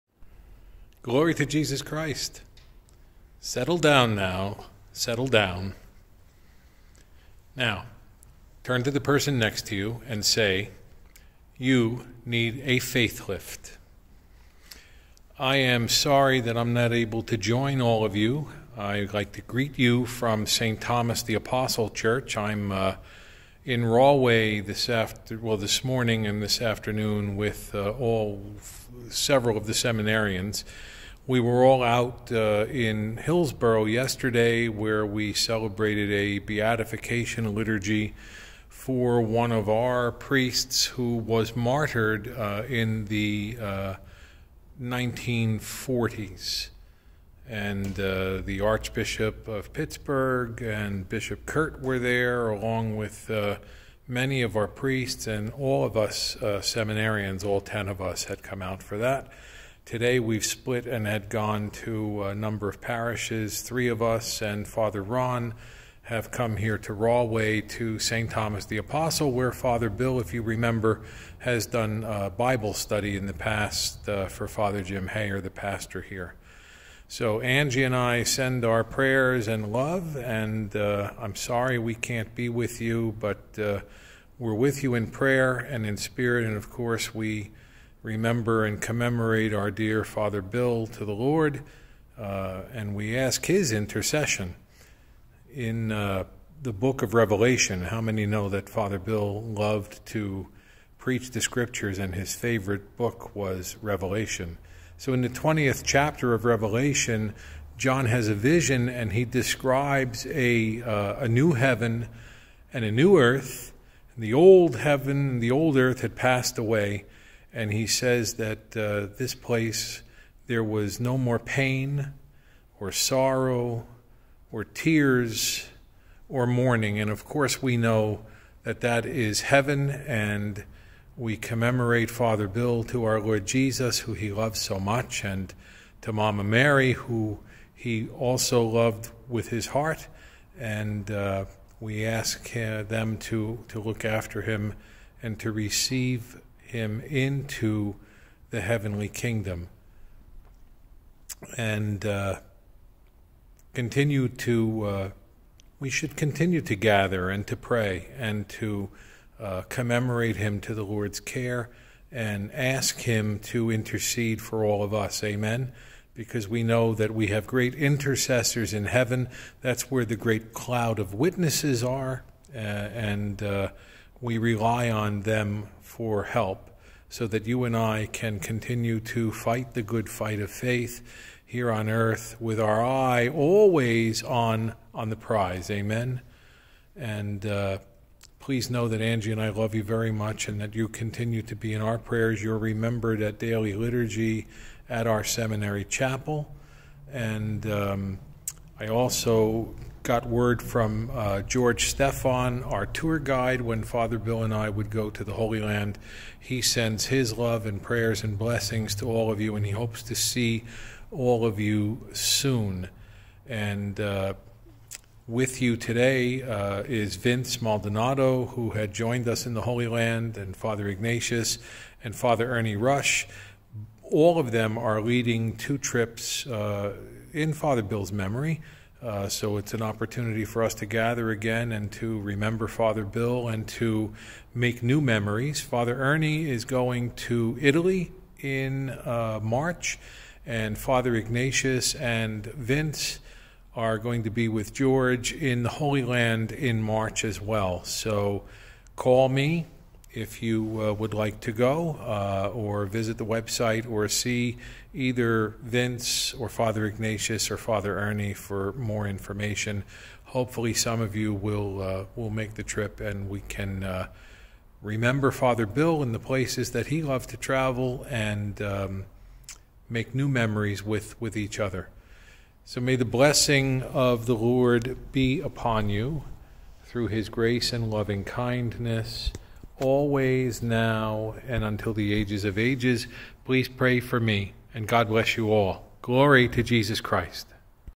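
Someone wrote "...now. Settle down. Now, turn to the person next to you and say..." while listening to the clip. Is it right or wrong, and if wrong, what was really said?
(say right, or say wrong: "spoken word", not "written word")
right.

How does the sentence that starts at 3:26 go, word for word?
He sends his love and prayers and blessings to all of you, and he hopes to see all of you soon.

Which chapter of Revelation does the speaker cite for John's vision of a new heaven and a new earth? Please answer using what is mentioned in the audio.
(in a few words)
20th.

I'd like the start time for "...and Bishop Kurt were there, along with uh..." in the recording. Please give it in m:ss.
0:50.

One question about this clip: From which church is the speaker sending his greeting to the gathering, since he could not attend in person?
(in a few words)
St. Thomas the Apostle Church.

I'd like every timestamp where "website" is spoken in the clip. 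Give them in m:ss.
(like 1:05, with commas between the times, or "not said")
4:13.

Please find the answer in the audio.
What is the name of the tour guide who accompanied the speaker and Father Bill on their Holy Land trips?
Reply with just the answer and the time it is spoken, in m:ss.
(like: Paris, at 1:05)
George Stefan, at 3:21.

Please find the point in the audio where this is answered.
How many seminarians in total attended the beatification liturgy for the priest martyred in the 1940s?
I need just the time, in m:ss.
0:57.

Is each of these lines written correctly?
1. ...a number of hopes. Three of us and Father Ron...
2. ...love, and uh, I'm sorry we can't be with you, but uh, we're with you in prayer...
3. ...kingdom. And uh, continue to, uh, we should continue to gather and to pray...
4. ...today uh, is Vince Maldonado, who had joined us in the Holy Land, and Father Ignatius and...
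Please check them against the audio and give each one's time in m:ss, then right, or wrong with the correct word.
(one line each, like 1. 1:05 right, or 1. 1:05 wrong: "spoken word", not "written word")
1. 1:02 wrong: "parishes", not "hopes"
2. 1:19 right
3. 2:29 right
4. 3:35 right.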